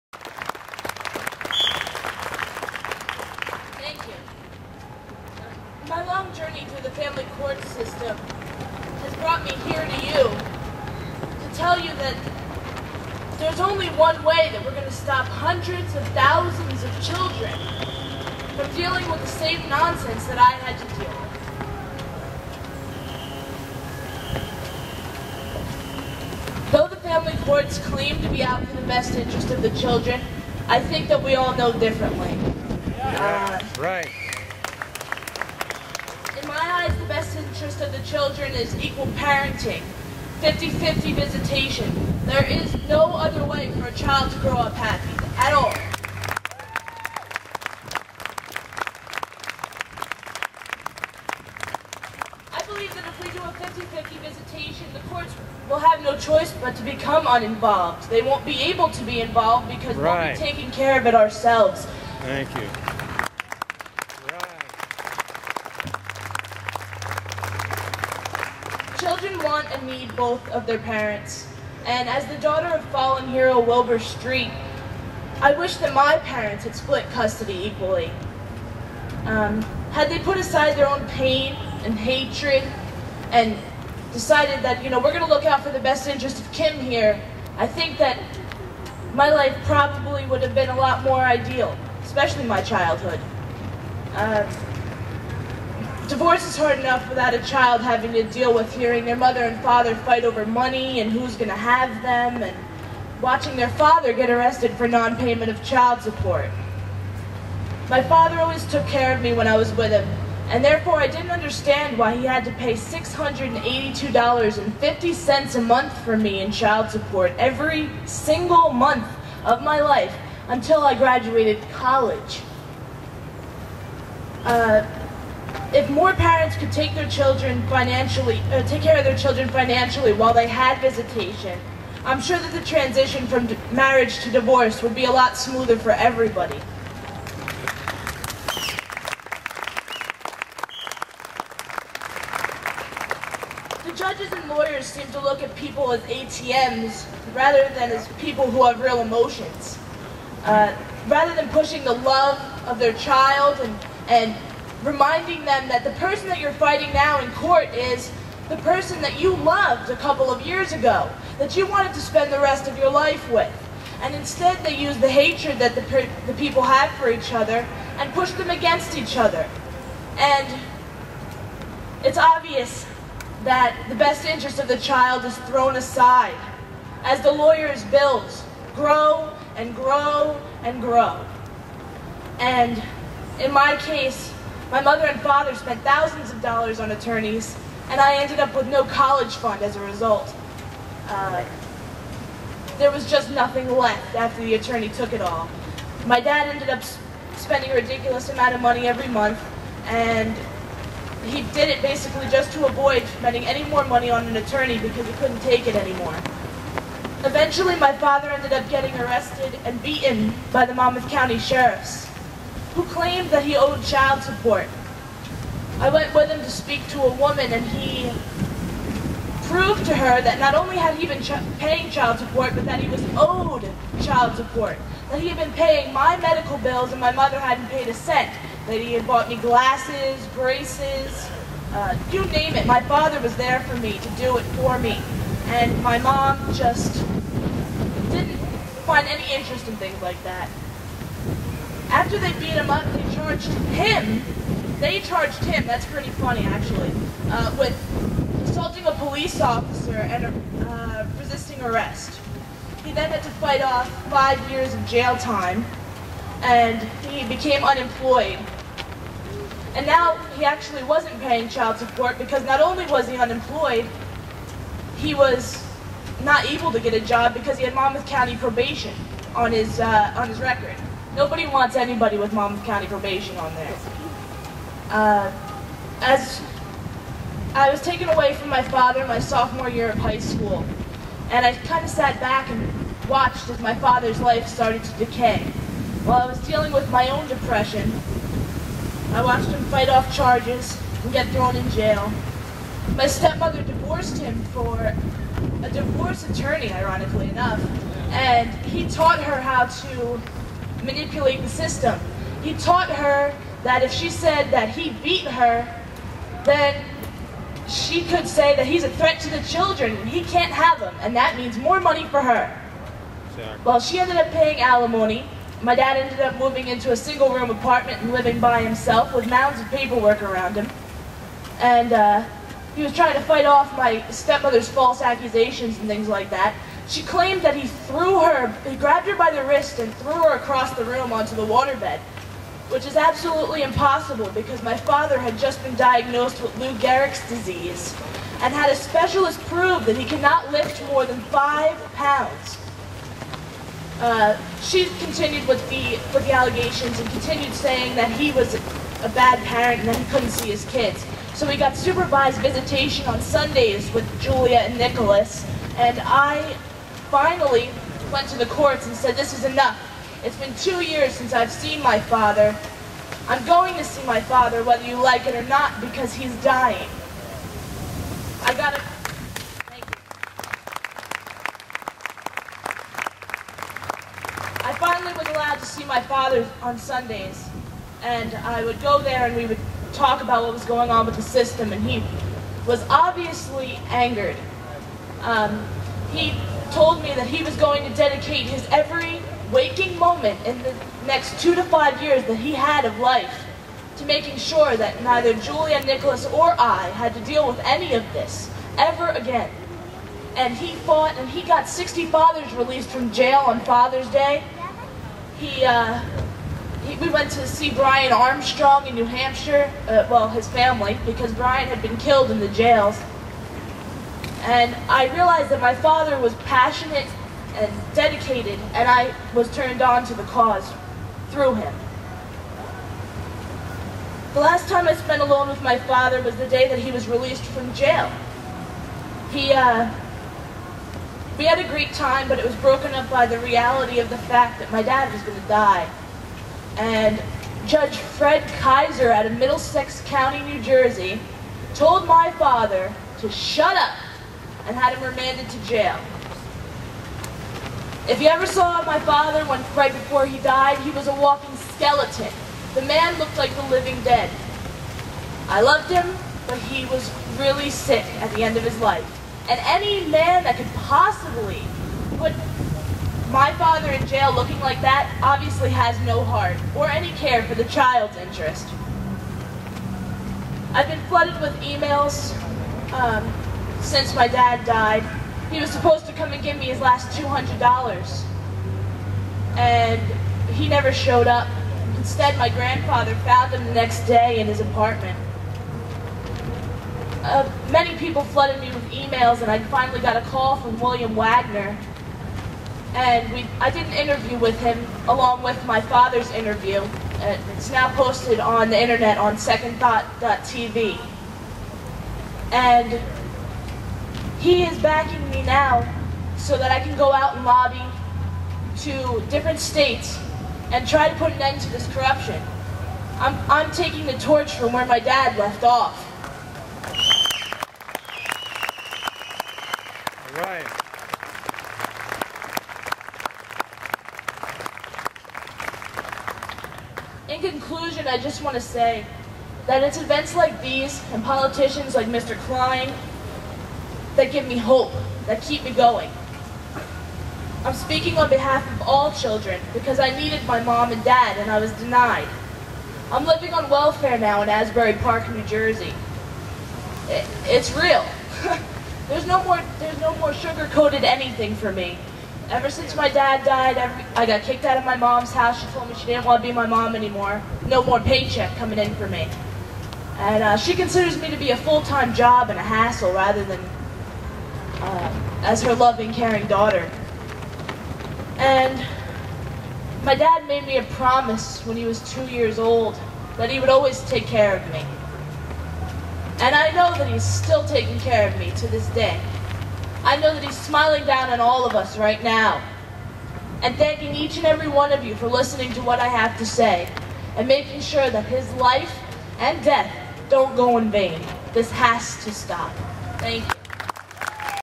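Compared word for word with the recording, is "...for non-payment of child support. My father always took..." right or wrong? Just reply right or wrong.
right.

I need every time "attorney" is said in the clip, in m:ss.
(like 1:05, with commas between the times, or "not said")
3:06, 3:14, 3:24, 4:56.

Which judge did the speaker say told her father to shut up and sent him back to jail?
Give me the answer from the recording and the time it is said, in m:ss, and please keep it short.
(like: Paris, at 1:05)
Fred Kaiser, at 7:17.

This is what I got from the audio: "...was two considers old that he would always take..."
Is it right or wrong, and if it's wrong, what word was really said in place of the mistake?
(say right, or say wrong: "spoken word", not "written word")
wrong: "years", not "considers".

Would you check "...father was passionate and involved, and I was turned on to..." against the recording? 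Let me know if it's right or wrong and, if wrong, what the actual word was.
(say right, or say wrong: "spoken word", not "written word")
wrong: "dedicated", not "involved".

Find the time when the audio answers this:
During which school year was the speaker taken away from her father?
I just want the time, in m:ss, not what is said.
4:39.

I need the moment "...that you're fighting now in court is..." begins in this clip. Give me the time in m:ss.
2:36.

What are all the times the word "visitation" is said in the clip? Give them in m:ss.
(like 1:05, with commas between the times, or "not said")
0:41, 0:54, 2:10, 5:52.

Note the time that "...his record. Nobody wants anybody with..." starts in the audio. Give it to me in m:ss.
4:30.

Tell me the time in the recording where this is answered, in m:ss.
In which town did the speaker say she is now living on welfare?
9:04.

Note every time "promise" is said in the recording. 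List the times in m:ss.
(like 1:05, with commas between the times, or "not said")
9:30.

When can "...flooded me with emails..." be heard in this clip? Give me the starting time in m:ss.
8:08.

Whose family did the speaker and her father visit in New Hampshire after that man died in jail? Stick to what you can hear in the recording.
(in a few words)
Brian Armstrong.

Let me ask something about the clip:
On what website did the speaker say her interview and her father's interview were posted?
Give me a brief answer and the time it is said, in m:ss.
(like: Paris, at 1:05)
secondthought.tv, at 8:19.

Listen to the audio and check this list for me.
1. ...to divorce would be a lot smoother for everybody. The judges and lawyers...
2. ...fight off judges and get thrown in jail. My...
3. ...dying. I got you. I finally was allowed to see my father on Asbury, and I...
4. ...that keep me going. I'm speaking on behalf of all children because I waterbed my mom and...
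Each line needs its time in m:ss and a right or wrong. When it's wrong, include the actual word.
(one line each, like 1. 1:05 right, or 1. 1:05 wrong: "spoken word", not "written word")
1. 2:14 right
2. 4:49 wrong: "charges", not "judges"
3. 6:06 wrong: "Sundays", not "Asbury"
4. 8:55 wrong: "needed", not "waterbed".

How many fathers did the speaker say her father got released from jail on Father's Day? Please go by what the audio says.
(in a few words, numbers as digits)
60.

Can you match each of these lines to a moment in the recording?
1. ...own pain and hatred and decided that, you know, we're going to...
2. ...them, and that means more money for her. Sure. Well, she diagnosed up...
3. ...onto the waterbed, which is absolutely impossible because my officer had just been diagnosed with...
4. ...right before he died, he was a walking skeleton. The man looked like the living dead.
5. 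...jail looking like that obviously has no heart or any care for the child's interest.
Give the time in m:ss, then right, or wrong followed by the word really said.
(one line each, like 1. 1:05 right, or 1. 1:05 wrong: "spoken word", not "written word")
1. 1:20 right
2. 5:10 wrong: "ended", not "diagnosed"
3. 5:31 wrong: "father", not "officer"
4. 7:29 right
5. 7:44 right.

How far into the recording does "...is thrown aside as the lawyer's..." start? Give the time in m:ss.
2:55.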